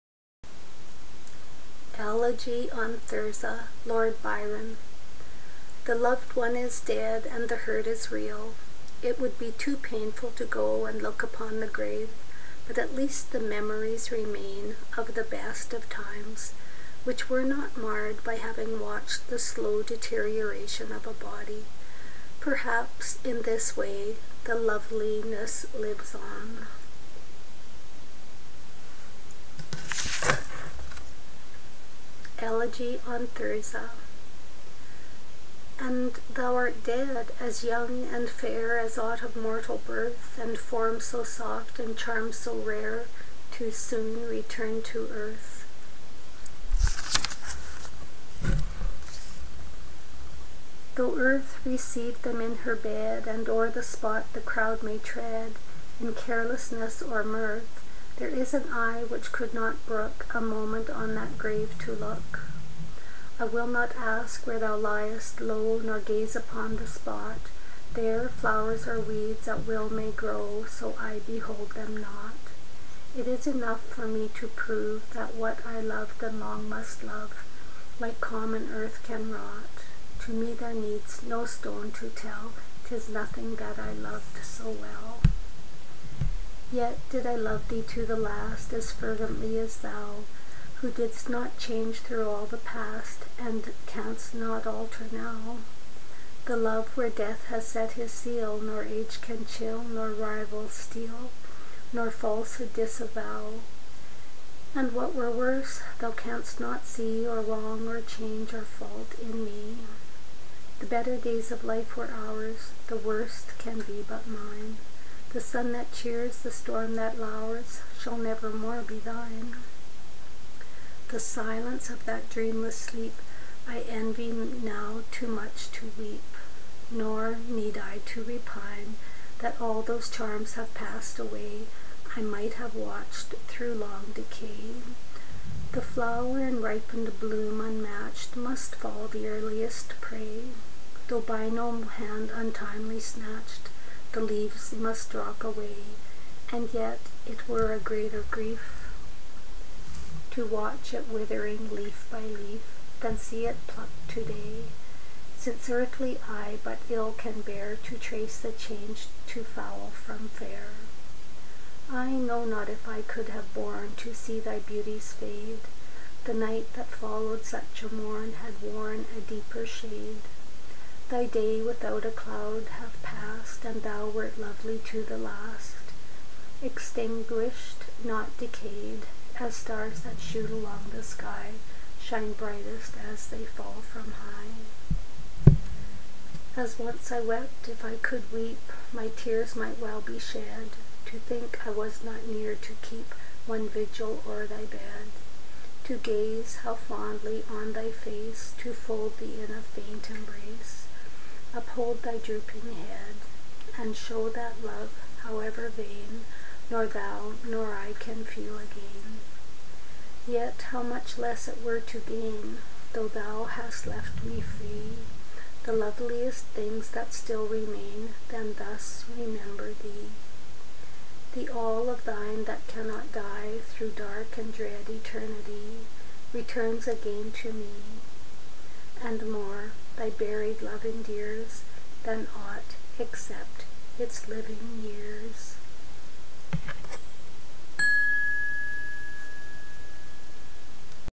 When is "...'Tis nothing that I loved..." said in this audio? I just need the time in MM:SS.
01:22.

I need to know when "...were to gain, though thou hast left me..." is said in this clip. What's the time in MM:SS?
03:31.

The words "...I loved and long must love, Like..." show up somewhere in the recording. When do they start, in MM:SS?
01:15.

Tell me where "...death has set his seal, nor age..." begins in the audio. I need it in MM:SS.
01:37.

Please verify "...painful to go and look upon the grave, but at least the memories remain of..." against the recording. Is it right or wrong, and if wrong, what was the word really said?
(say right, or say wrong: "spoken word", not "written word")
right.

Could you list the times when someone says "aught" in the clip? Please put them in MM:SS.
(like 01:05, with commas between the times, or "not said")
00:38, 03:52.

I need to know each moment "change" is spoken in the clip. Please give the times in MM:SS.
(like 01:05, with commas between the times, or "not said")
01:31, 01:47, 02:38.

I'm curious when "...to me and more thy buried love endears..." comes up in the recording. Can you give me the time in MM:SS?
03:47.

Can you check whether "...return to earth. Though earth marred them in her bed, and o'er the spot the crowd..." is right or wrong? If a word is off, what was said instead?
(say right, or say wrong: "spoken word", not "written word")
wrong: "received", not "marred".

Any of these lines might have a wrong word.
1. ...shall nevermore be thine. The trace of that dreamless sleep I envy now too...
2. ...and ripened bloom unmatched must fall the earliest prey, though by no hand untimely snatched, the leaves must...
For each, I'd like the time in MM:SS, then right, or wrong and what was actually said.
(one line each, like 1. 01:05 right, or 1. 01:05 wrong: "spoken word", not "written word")
1. 01:58 wrong: "silence", not "trace"
2. 02:16 right.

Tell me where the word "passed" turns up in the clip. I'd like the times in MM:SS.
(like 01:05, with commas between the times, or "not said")
02:10, 02:53.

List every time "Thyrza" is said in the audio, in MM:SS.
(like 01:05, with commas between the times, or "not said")
00:03, 00:33.